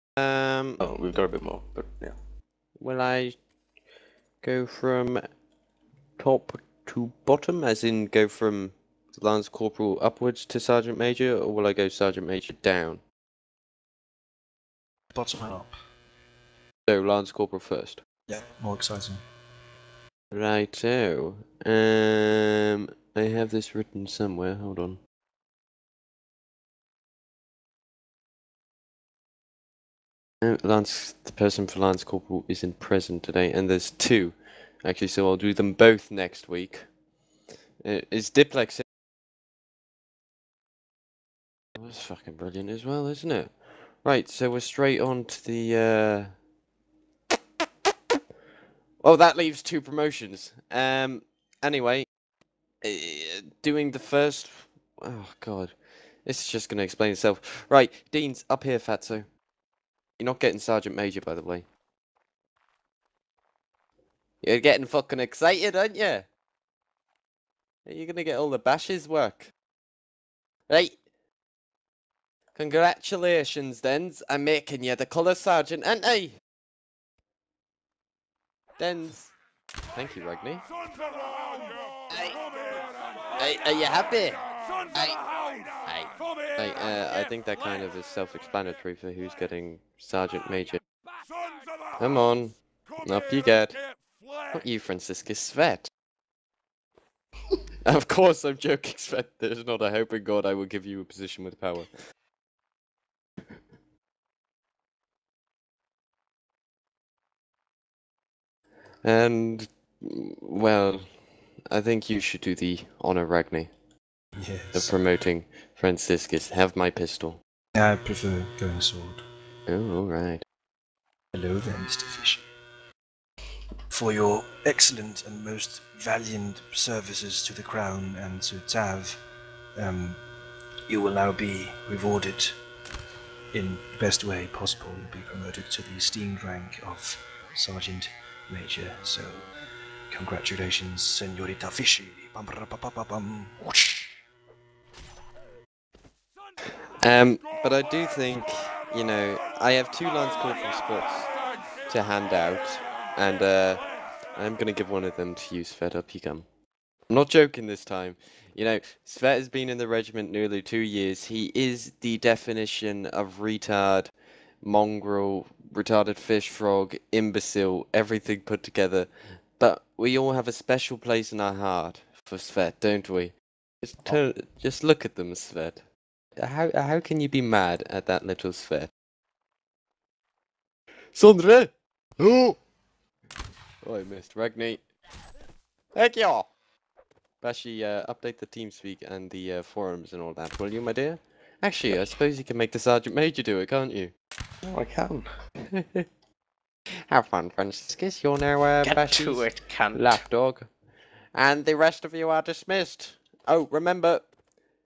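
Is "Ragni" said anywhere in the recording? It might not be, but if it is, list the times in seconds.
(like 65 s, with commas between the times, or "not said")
113 s, 184 s.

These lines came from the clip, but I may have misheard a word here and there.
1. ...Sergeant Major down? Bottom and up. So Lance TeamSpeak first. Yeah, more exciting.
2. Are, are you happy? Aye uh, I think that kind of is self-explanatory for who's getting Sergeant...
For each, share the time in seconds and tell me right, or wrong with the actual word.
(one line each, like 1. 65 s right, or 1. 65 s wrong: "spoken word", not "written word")
1. 11 s wrong: "Corporal", not "TeamSpeak"
2. 80 s right.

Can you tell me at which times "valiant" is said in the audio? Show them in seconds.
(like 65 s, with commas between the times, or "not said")
125 s.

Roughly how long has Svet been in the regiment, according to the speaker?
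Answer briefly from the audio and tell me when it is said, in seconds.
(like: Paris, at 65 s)
nearly 2 years, at 160 s.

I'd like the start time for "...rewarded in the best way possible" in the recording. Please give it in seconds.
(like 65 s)
131 s.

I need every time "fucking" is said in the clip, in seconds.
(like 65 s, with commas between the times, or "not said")
42 s, 64 s.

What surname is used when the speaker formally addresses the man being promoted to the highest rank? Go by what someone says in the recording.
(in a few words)
Fisher.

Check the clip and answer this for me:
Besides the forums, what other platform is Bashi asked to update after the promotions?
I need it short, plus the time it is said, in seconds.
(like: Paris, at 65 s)
TeamSpeak, at 188 s.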